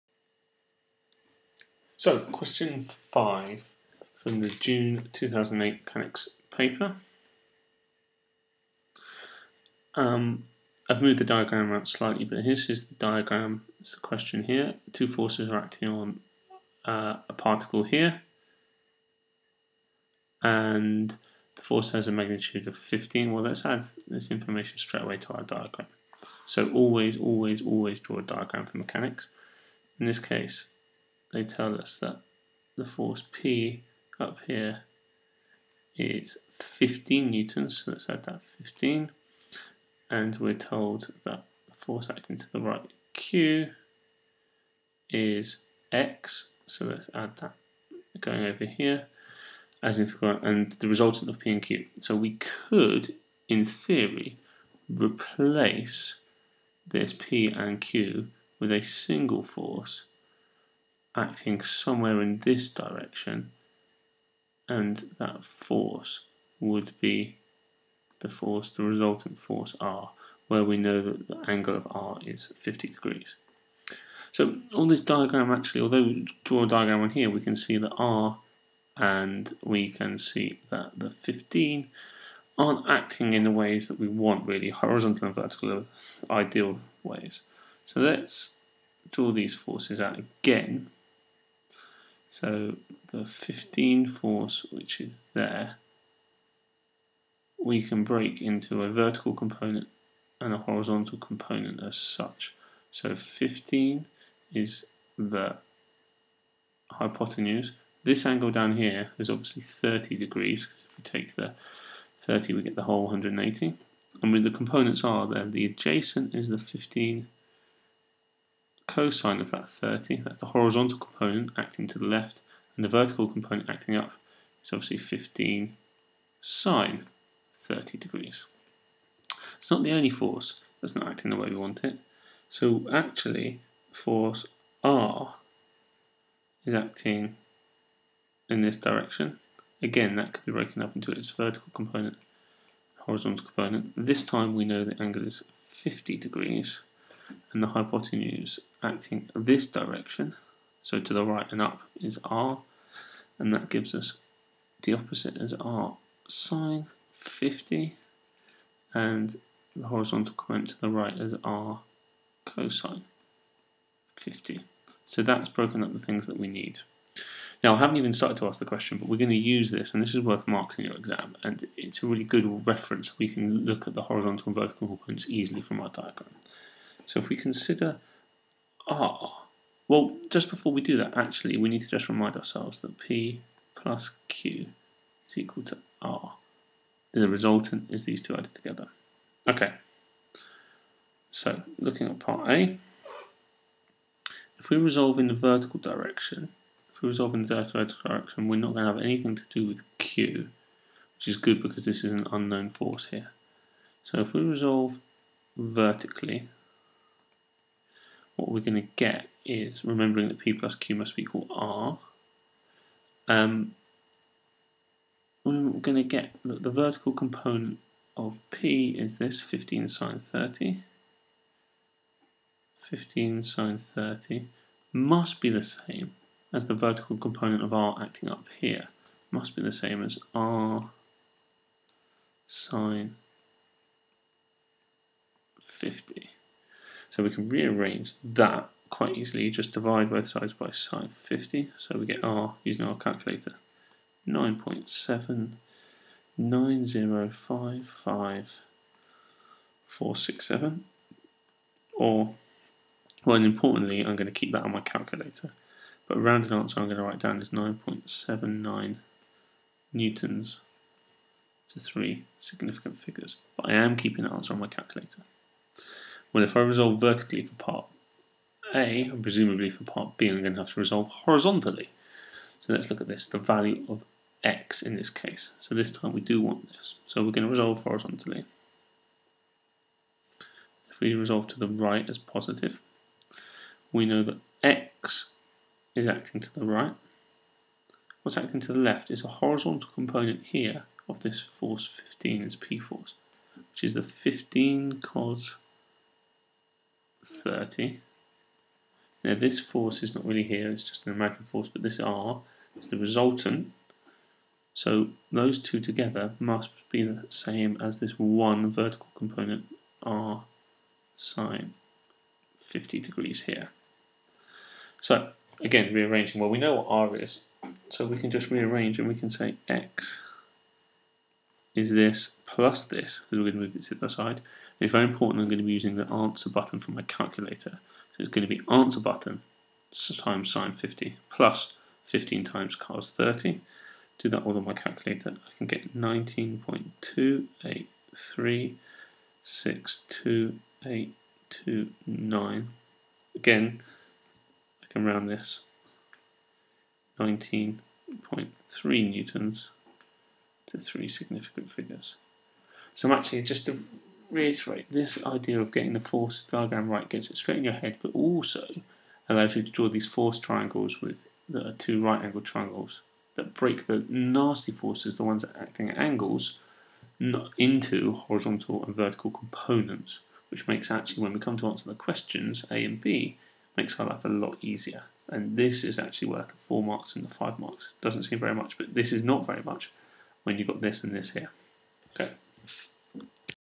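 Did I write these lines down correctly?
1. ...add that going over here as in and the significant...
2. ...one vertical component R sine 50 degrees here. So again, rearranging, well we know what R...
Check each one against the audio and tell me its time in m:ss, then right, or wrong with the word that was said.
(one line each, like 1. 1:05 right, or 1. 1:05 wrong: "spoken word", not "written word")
1. 0:47 wrong: "resultant", not "significant"
2. 5:08 right.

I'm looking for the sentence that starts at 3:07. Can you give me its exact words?
The resultant is these two added together.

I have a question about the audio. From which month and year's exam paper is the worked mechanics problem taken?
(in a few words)
June 2008.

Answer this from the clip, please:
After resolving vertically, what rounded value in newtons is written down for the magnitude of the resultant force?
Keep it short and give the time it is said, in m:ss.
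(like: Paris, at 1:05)
9.79 newtons, at 4:17.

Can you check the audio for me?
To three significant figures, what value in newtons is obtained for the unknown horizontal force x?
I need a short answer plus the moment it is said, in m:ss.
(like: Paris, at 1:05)
19.3 newtons, at 5:47.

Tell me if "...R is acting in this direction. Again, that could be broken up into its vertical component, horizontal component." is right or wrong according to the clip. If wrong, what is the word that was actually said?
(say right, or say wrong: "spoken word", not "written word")
right.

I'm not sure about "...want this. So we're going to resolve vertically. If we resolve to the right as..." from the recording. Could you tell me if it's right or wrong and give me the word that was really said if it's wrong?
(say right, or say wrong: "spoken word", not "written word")
wrong: "horizontally", not "vertically".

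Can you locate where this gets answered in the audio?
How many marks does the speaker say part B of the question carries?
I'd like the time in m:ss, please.
6:17.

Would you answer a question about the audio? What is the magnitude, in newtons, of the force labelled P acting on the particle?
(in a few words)
15 newtons.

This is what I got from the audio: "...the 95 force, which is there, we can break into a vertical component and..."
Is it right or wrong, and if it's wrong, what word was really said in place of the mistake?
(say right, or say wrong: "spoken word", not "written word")
wrong: "15", not "95".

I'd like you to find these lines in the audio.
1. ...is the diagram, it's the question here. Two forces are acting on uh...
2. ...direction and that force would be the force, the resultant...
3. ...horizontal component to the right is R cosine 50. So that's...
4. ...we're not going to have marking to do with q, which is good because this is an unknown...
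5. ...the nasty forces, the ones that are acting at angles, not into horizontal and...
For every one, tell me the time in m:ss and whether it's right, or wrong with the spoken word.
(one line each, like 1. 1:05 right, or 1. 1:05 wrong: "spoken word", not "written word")
1. 0:12 right
2. 1:02 right
3. 2:39 right
4. 3:18 wrong: "anything", not "marking"
5. 6:03 right.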